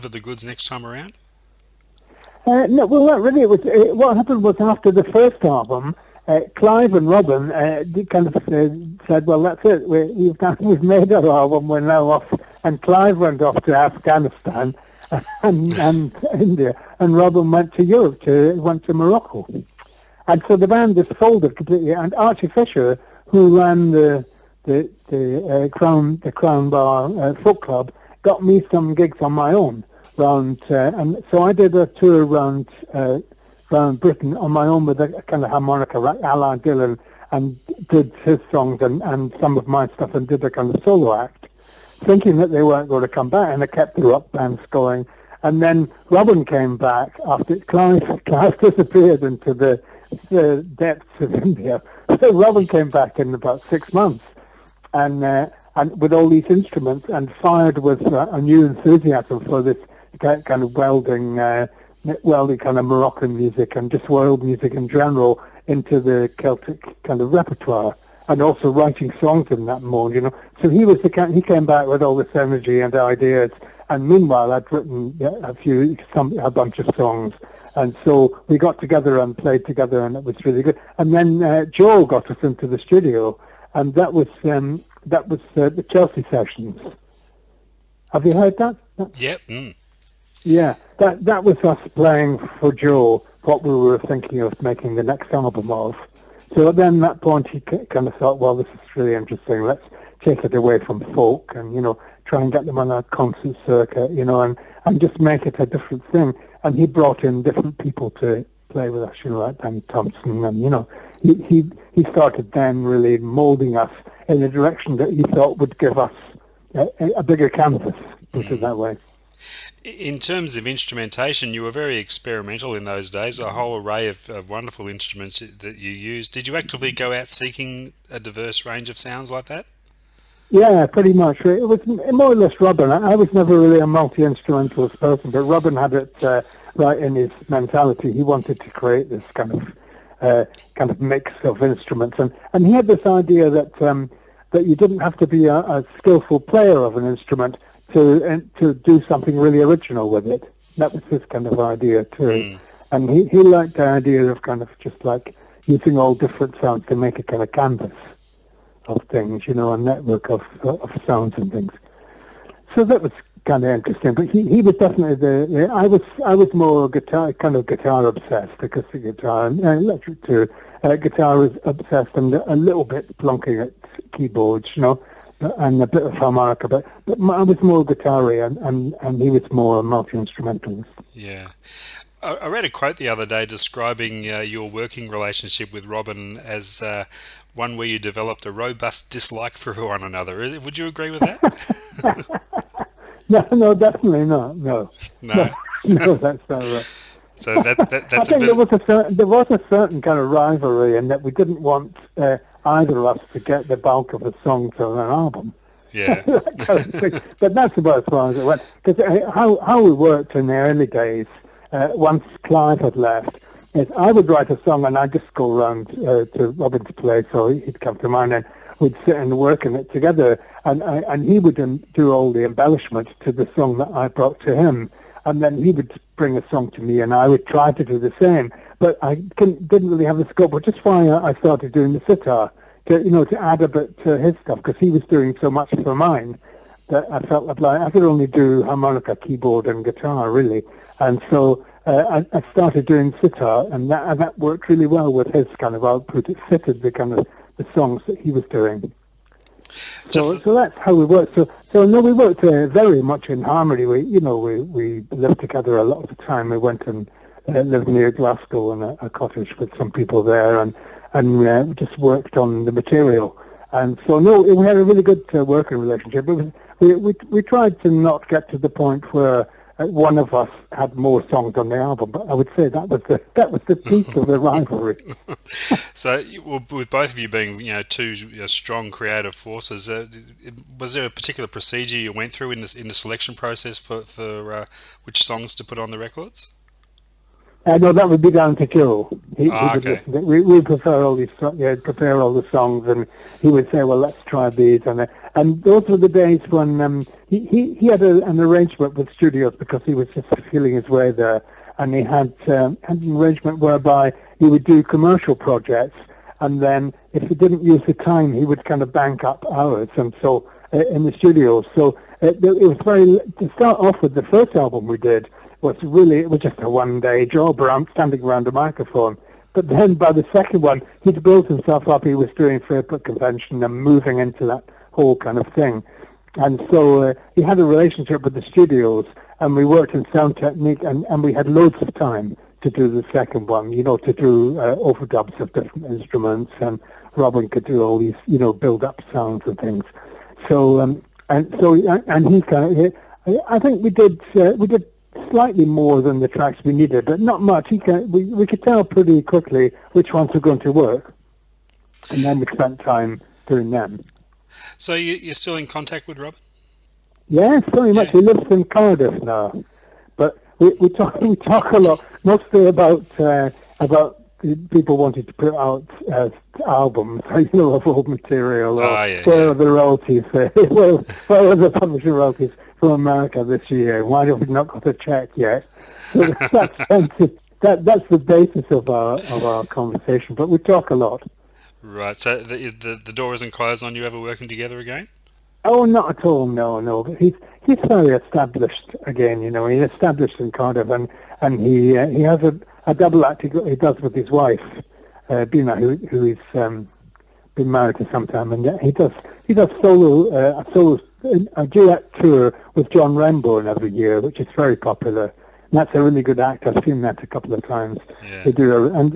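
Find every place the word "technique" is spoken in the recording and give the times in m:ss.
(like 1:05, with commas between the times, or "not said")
5:30.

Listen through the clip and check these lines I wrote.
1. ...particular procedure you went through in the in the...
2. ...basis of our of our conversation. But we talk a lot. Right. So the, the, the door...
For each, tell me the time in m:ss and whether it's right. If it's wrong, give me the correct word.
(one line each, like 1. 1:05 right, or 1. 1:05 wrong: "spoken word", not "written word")
1. 4:41 right
2. 6:18 right.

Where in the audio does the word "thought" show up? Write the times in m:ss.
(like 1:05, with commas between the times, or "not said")
1:38, 1:55.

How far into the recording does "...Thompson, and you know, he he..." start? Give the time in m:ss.
1:49.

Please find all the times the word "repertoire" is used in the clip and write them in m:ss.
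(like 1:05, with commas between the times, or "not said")
1:07.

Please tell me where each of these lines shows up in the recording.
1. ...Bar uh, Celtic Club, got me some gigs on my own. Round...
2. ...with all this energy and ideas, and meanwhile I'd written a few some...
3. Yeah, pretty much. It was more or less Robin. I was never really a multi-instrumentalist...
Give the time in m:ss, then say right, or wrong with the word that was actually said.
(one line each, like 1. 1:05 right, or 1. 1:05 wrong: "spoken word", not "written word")
1. 0:26 wrong: "Folk", not "Celtic"
2. 1:11 right
3. 2:10 right.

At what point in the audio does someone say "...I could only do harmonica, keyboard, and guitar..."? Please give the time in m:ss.
3:57.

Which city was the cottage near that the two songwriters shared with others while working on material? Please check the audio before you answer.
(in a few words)
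Glasgow.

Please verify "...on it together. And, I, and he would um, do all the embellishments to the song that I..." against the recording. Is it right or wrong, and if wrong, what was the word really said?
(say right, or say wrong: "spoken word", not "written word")
right.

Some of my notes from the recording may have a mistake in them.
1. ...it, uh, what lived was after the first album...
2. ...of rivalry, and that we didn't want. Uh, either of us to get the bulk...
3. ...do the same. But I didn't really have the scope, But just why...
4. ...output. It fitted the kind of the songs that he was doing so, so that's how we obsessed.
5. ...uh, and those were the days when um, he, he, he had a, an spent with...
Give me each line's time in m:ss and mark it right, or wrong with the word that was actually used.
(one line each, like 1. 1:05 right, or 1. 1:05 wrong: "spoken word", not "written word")
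1. 0:03 wrong: "happened", not "lived"
2. 3:20 right
3. 3:47 right
4. 4:05 wrong: "worked", not "obsessed"
5. 4:55 wrong: "arrangement", not "spent".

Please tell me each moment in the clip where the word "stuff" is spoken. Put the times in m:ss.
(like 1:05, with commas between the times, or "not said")
0:39, 3:54.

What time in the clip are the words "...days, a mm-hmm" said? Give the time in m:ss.
2:03.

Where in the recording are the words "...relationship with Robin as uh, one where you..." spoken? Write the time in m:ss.
3:05.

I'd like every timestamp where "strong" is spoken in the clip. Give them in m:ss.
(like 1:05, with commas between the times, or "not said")
4:38.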